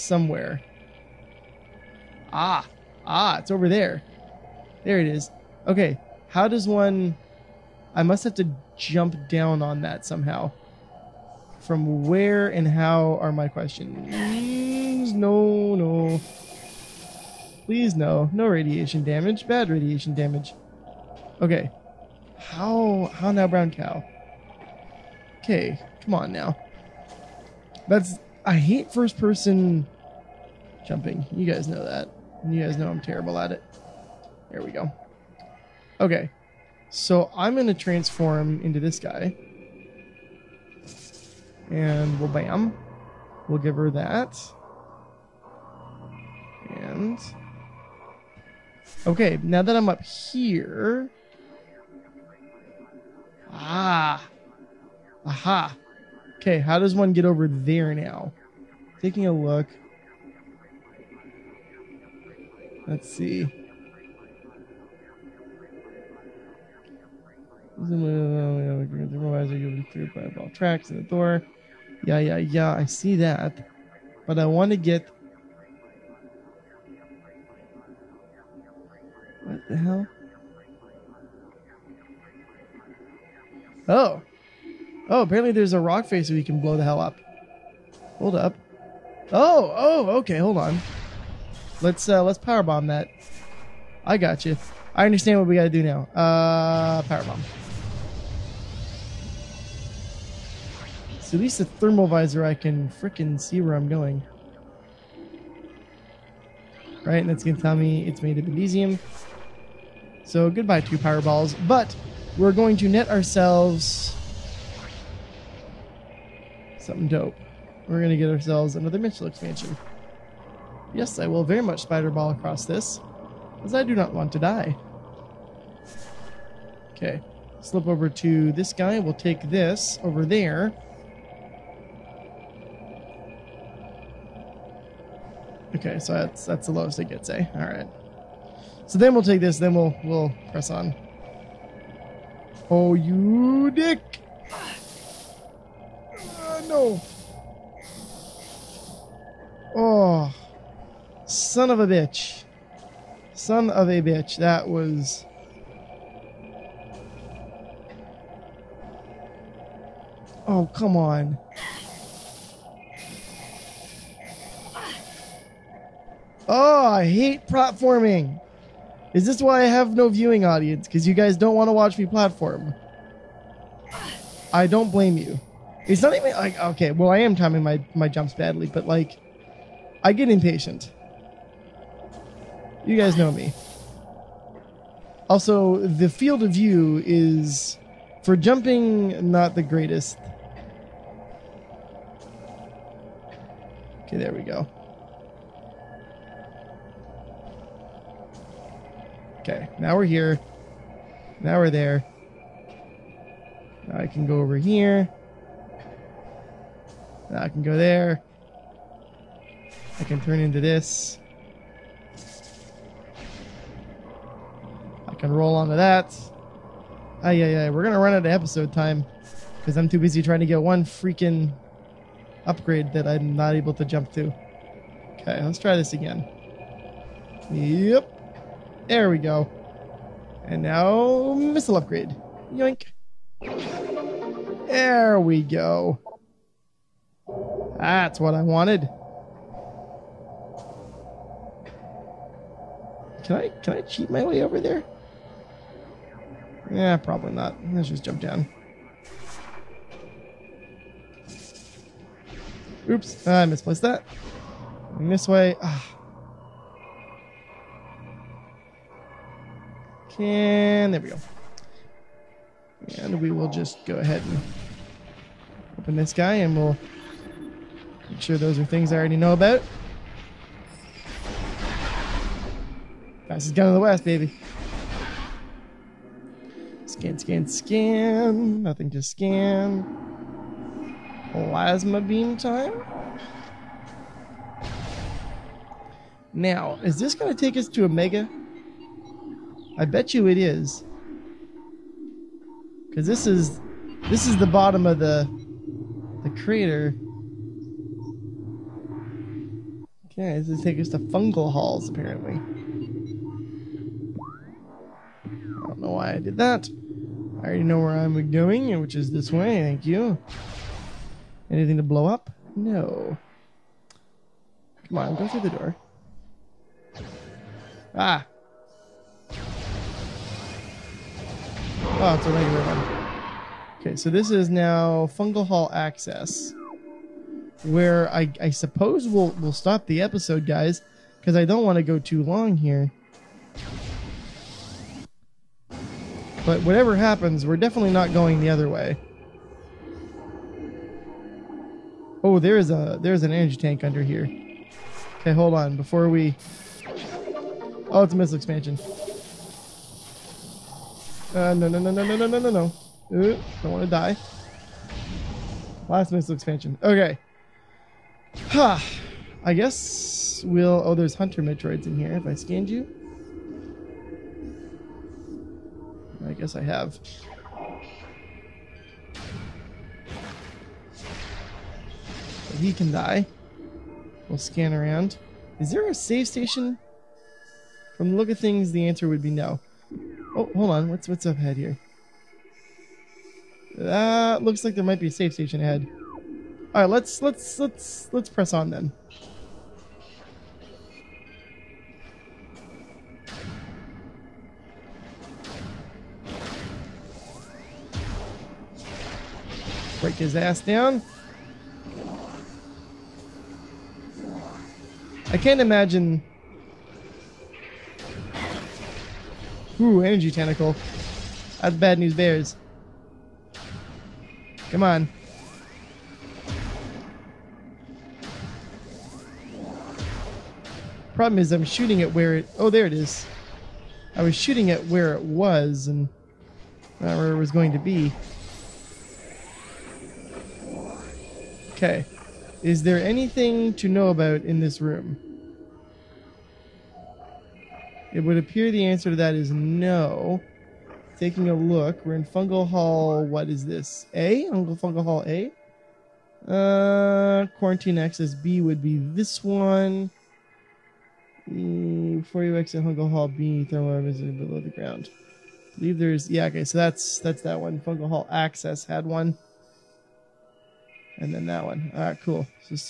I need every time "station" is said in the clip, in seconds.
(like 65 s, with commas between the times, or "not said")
376 s, 385 s.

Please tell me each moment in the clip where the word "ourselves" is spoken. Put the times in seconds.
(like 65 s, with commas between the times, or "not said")
113 s, 118 s.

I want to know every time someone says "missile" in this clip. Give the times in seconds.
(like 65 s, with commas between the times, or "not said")
118 s, 231 s, 348 s, 356 s.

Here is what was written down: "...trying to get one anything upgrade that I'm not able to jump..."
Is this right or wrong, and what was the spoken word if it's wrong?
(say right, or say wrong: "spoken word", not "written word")
wrong: "freaking", not "anything".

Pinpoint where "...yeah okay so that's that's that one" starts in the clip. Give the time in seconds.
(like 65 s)
456 s.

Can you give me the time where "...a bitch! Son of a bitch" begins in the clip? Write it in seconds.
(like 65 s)
151 s.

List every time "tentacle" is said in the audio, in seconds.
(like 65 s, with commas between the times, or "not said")
410 s.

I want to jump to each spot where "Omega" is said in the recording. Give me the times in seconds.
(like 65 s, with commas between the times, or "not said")
287 s.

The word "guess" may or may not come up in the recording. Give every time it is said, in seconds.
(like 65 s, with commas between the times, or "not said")
359 s, 366 s.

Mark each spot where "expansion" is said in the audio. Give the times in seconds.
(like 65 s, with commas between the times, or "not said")
119 s, 348 s, 356 s.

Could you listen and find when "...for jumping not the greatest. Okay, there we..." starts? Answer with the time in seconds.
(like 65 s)
188 s.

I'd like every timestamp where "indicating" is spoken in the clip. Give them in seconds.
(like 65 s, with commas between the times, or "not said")
not said.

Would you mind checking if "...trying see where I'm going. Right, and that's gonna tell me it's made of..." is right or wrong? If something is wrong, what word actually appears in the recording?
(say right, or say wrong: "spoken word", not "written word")
wrong: "freaking", not "trying".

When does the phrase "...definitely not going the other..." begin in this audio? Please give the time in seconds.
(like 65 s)
337 s.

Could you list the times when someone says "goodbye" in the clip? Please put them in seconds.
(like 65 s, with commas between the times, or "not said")
110 s.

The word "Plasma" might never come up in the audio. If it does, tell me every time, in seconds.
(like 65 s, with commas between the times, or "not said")
281 s.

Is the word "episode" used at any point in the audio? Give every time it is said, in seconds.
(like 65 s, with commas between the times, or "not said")
218 s, 330 s.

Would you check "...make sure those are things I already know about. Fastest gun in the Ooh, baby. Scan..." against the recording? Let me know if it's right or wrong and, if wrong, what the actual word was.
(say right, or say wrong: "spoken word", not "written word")
wrong: "West", not "Ooh".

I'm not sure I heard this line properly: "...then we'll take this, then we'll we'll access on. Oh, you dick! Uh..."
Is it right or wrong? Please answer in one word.
wrong.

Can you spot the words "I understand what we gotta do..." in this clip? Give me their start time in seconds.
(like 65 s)
94 s.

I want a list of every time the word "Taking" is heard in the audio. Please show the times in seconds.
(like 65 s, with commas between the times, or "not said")
58 s, 441 s.